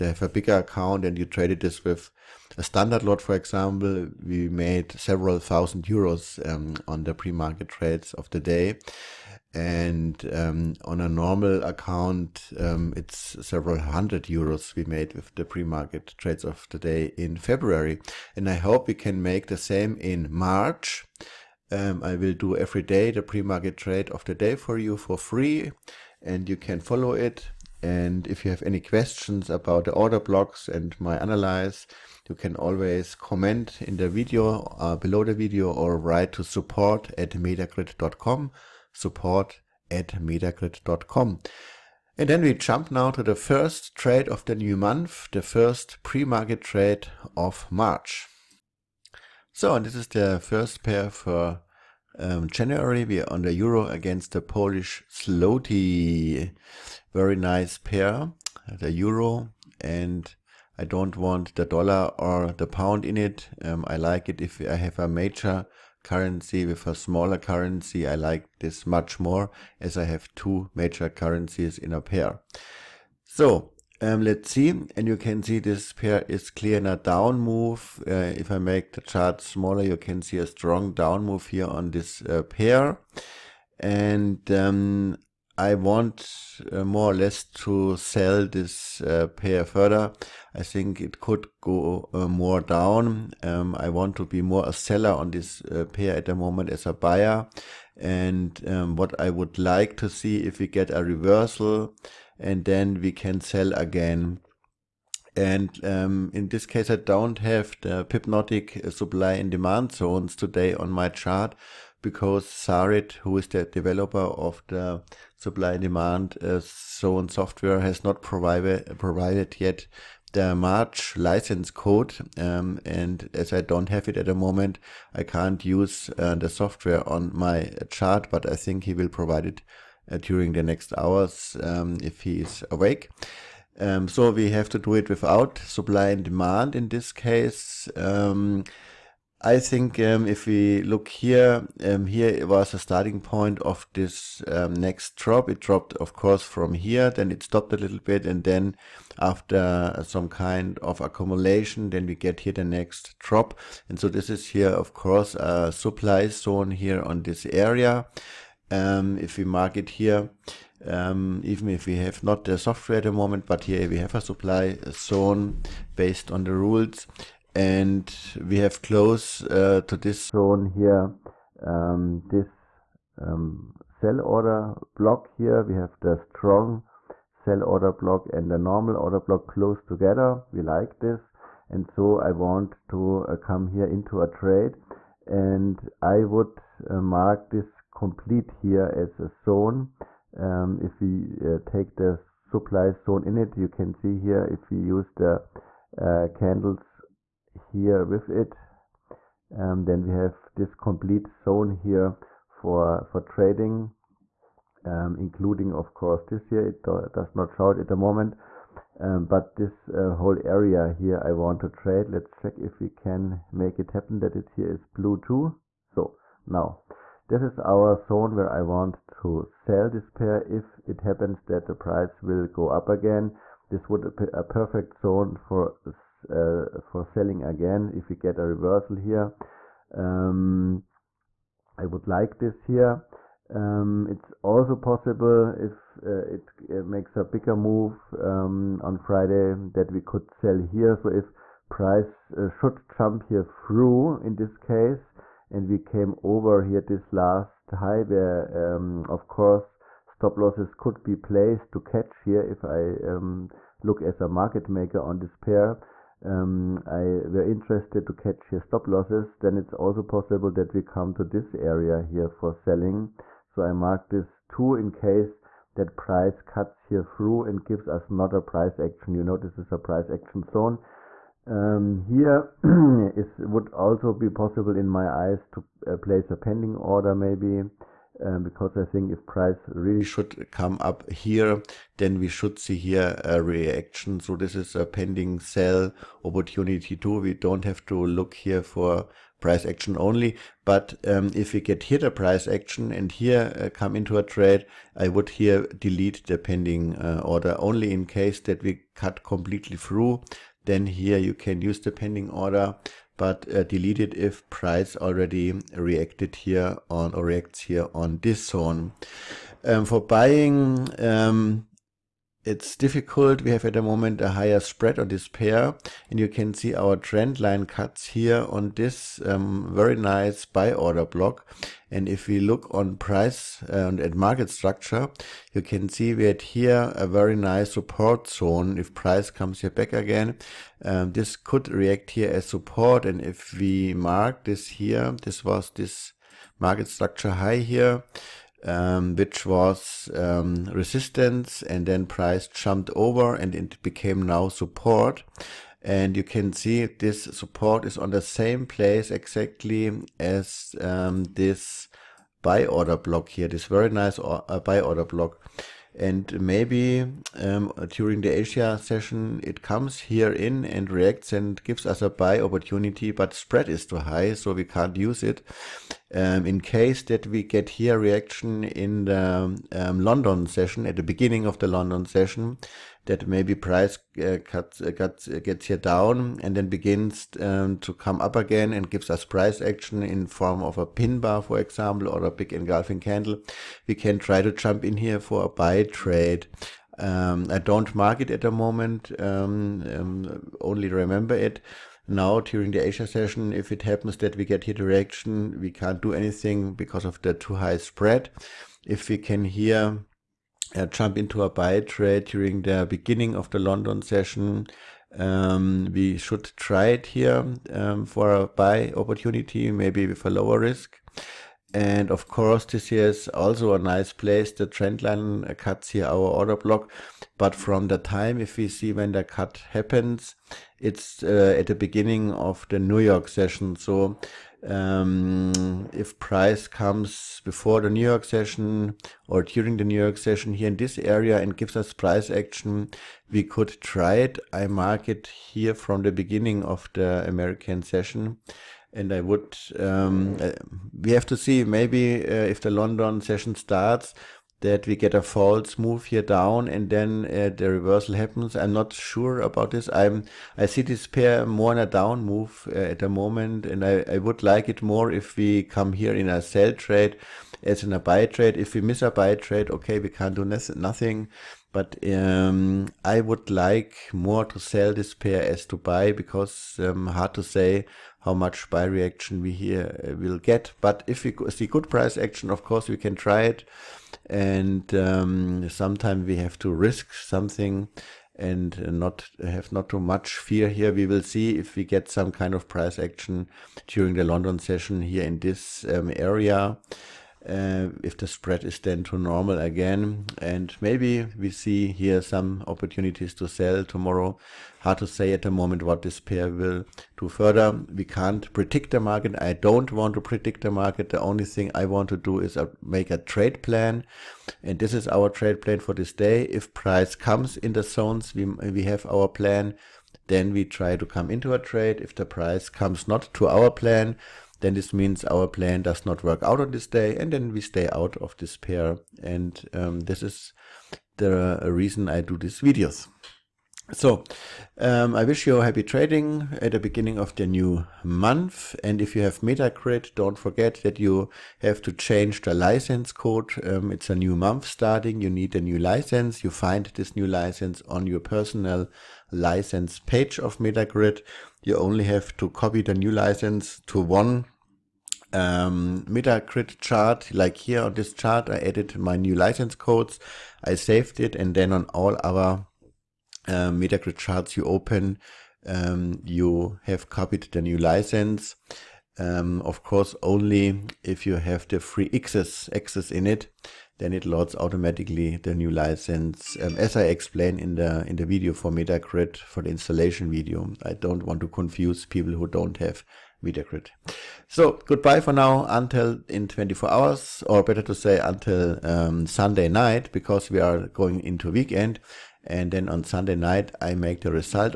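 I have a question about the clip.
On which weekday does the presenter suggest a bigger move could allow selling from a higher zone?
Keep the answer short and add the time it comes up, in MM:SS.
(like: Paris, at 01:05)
Friday, at 03:58.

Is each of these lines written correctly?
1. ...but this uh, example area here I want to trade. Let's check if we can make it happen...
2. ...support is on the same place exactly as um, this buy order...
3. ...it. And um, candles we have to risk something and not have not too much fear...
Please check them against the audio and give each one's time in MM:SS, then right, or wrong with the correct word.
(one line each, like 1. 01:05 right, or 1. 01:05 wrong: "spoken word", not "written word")
1. 03:29 wrong: "whole", not "example"
2. 05:47 right
3. 07:53 wrong: "sometimes", not "candles".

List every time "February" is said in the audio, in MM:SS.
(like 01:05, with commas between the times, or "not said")
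00:17.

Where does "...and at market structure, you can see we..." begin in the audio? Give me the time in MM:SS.
05:23.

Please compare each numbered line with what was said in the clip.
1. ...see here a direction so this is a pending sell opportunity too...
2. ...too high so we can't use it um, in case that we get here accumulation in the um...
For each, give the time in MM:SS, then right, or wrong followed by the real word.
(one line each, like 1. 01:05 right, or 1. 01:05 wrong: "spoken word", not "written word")
1. 04:42 wrong: "reaction", not "direction"
2. 06:03 wrong: "reaction", not "accumulation".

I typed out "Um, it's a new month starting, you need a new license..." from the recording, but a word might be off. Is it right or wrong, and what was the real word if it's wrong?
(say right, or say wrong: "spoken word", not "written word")
right.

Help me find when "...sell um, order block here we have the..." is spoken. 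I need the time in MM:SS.
02:53.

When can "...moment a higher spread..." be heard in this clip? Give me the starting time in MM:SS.
05:13.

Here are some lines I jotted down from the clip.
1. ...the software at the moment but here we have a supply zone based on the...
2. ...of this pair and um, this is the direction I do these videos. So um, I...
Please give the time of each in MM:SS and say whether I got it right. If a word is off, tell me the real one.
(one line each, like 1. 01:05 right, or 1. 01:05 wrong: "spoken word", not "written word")
1. 02:42 right
2. 08:38 wrong: "reason", not "direction".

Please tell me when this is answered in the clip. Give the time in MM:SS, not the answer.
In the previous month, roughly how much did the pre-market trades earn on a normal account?
00:13.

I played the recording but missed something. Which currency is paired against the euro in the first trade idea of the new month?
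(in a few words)
Polish zloty.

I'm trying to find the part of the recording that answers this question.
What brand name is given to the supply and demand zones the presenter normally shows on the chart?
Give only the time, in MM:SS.
01:48.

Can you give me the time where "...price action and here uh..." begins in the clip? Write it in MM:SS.
04:52.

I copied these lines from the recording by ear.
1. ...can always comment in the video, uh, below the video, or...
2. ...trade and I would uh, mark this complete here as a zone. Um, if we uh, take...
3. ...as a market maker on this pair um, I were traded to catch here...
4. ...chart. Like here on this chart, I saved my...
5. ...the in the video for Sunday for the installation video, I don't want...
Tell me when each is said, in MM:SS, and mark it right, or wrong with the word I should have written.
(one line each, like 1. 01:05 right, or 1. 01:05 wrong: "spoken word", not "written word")
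1. 00:32 right
2. 03:04 right
3. 04:14 wrong: "interested", not "traded"
4. 09:06 wrong: "added", not "saved"
5. 09:27 wrong: "Metagrid", not "Sunday".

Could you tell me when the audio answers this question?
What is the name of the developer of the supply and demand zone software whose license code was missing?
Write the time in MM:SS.
01:52.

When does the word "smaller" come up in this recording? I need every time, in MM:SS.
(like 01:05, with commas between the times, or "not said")
01:06, 01:19.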